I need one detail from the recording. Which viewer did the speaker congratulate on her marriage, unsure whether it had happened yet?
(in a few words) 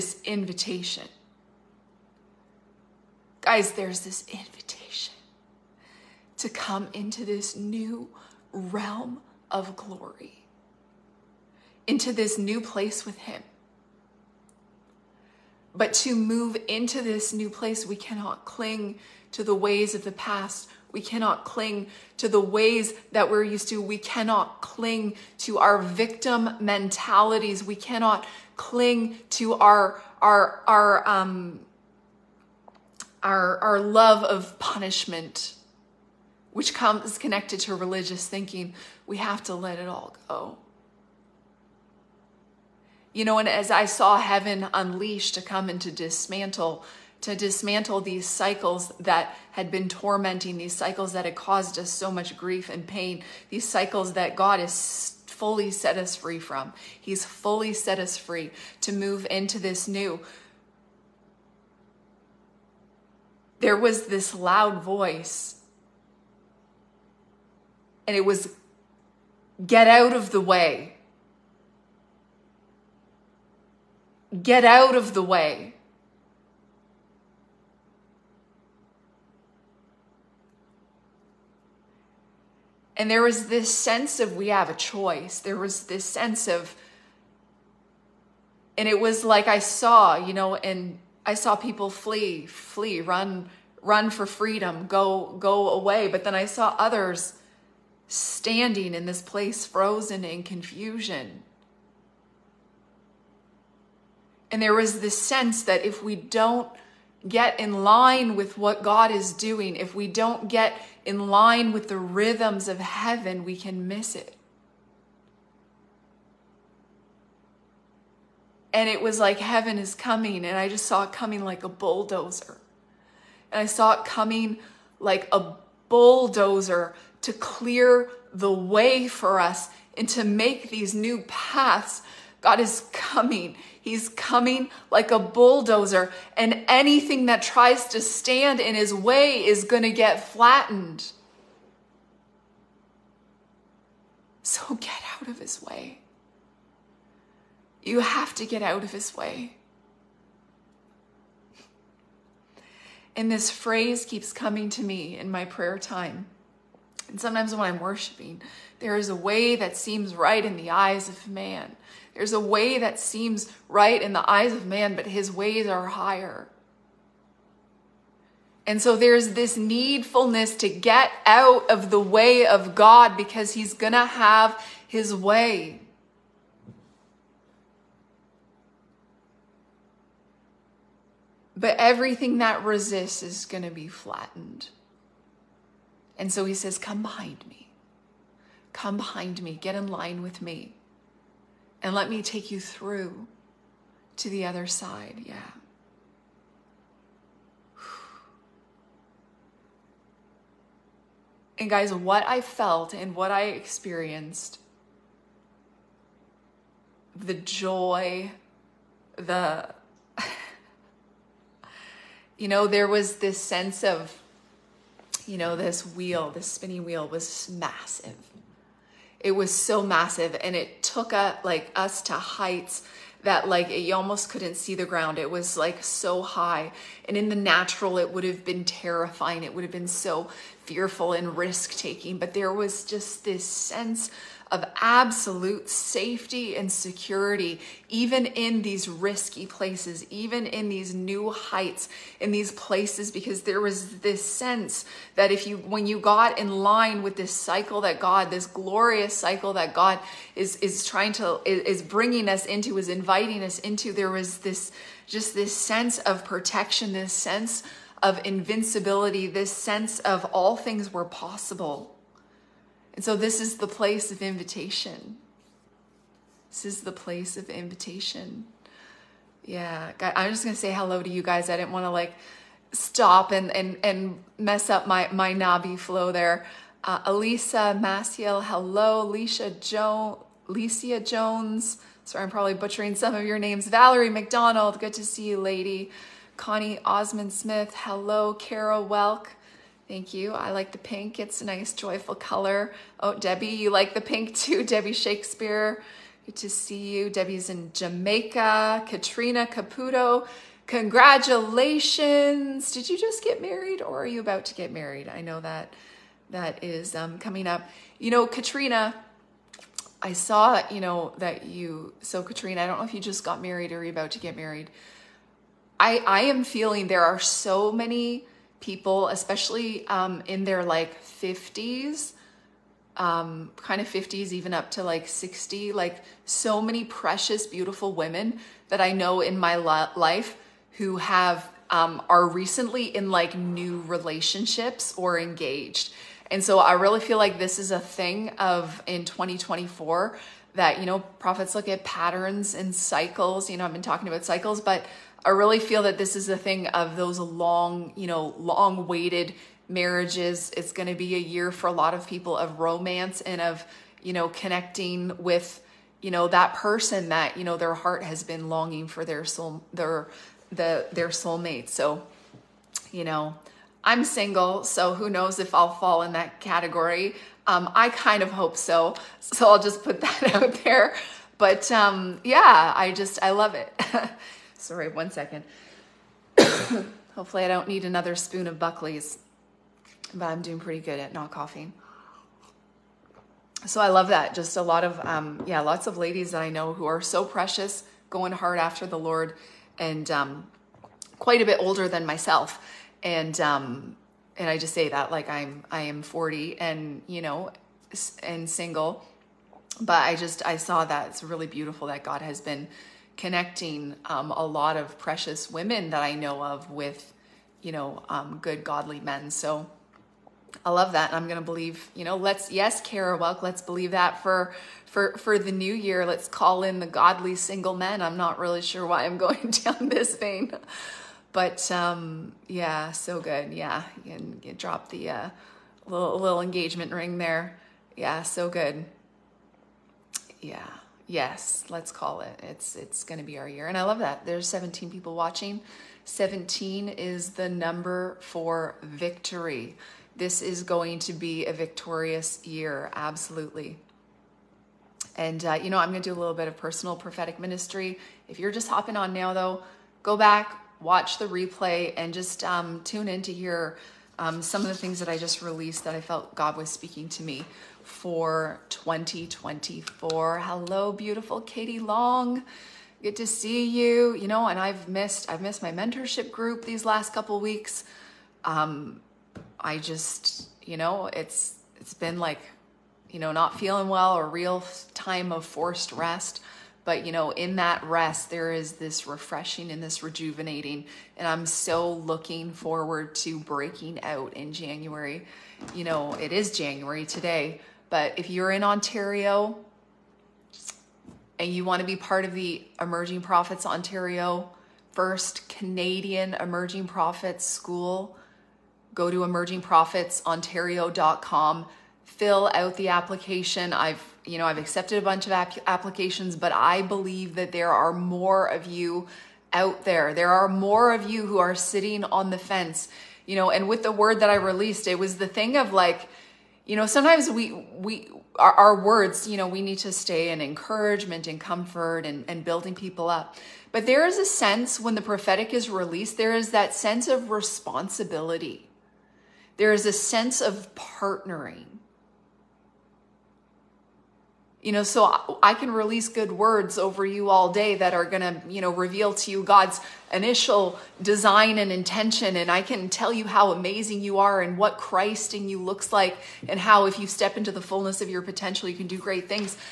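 Katrina Caputo.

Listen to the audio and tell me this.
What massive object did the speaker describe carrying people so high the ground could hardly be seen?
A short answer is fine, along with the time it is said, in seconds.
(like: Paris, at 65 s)
Spinning wheel, at 216 s.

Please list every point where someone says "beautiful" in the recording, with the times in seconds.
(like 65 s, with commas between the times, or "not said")
327 s, 401 s, 460 s.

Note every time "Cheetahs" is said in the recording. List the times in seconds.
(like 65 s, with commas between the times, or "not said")
not said.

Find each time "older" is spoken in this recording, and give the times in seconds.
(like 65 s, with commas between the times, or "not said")
391 s.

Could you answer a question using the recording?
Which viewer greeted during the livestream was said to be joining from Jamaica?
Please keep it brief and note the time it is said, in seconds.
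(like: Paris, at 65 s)
Debbie Shakespeare, at 294 s.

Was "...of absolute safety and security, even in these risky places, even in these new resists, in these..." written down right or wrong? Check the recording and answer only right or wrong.
wrong.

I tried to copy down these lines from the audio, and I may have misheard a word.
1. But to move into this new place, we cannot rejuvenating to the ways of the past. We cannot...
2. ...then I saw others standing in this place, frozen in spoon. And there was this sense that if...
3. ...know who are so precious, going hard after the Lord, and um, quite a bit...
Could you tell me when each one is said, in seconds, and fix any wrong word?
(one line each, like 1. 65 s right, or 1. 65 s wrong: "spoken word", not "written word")
1. 15 s wrong: "cling", not "rejuvenating"
2. 96 s wrong: "confusion", not "spoon"
3. 386 s right.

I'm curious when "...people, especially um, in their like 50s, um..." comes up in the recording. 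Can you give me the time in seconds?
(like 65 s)
318 s.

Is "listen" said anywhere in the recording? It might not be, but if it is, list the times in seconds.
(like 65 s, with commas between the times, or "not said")
not said.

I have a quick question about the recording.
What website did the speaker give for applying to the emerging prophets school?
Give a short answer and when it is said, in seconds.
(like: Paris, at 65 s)
emergingprophetsontario.com, at 499 s.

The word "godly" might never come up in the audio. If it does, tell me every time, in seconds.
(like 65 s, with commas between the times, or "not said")
408 s, 416 s.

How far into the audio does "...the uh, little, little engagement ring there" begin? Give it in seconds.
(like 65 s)
424 s.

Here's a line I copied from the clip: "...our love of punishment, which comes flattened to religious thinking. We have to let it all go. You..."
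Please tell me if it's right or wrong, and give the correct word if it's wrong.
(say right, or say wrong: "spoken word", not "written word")
wrong: "connected", not "flattened".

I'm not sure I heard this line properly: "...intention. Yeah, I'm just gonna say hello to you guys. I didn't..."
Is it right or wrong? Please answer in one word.
wrong.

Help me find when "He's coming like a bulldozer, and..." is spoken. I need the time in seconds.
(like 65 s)
133 s.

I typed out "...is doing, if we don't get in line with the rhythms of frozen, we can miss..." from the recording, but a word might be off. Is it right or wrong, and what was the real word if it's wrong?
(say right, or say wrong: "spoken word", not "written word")
wrong: "heaven", not "frozen".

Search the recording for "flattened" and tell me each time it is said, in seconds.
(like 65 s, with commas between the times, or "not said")
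140 s, 183 s.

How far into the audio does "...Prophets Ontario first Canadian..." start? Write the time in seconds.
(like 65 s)
493 s.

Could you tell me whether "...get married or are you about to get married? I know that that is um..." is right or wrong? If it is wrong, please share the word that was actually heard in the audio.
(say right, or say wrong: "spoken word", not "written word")
right.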